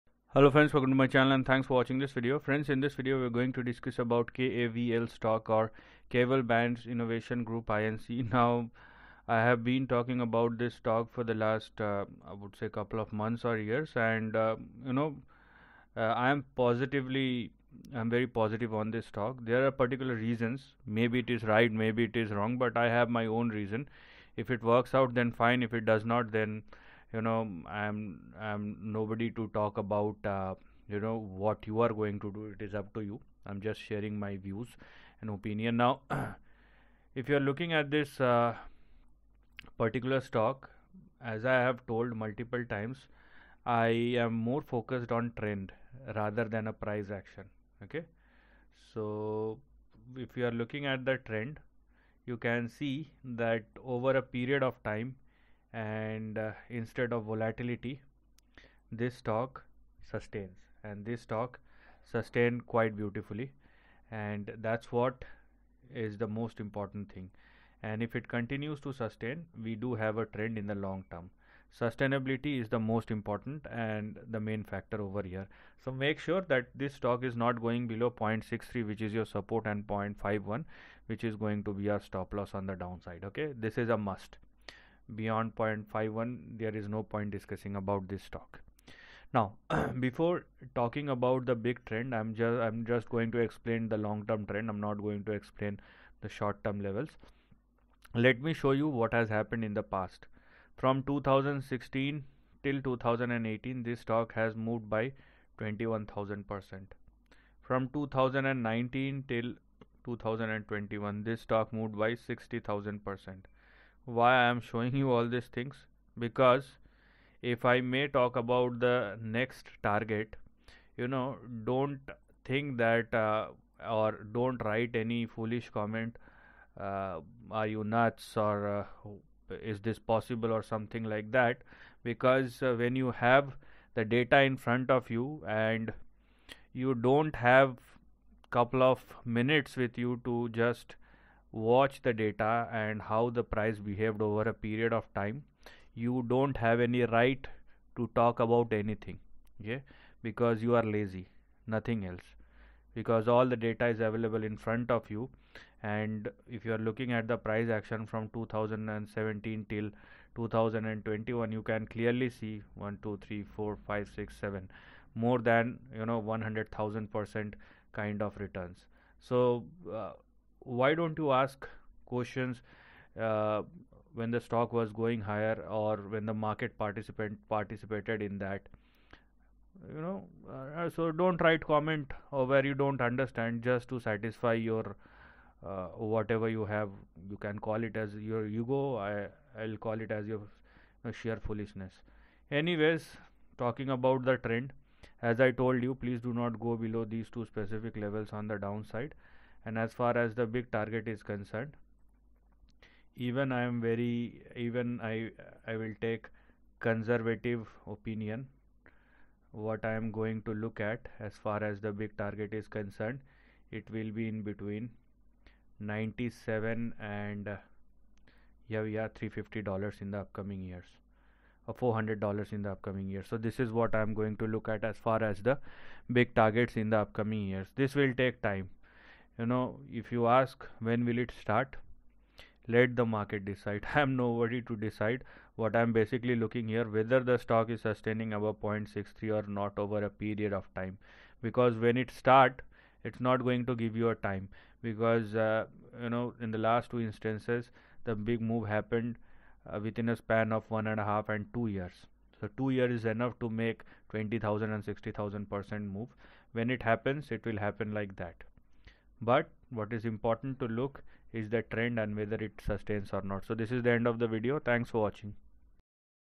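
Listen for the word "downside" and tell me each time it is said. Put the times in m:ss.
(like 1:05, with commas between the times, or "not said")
1:22, 3:18.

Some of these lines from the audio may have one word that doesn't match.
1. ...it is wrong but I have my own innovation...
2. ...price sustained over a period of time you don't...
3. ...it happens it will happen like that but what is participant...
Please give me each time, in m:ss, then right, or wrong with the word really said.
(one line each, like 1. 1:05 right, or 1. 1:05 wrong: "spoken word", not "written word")
1. 0:22 wrong: "reason", not "innovation"
2. 2:23 wrong: "behaved", not "sustained"
3. 4:16 wrong: "important", not "participant".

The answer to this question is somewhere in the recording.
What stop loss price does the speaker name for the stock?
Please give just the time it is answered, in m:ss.
1:19.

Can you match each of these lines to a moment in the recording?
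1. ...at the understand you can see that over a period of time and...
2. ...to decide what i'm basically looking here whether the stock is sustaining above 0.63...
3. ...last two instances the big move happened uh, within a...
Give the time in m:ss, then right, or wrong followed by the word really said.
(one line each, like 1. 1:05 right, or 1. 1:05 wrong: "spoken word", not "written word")
1. 0:50 wrong: "trend", not "understand"
2. 3:54 right
3. 4:06 right.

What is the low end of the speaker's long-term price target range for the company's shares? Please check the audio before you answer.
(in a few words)
97.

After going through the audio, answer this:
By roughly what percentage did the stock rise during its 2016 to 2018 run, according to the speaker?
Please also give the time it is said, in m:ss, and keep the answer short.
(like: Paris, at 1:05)
21000%, at 1:45.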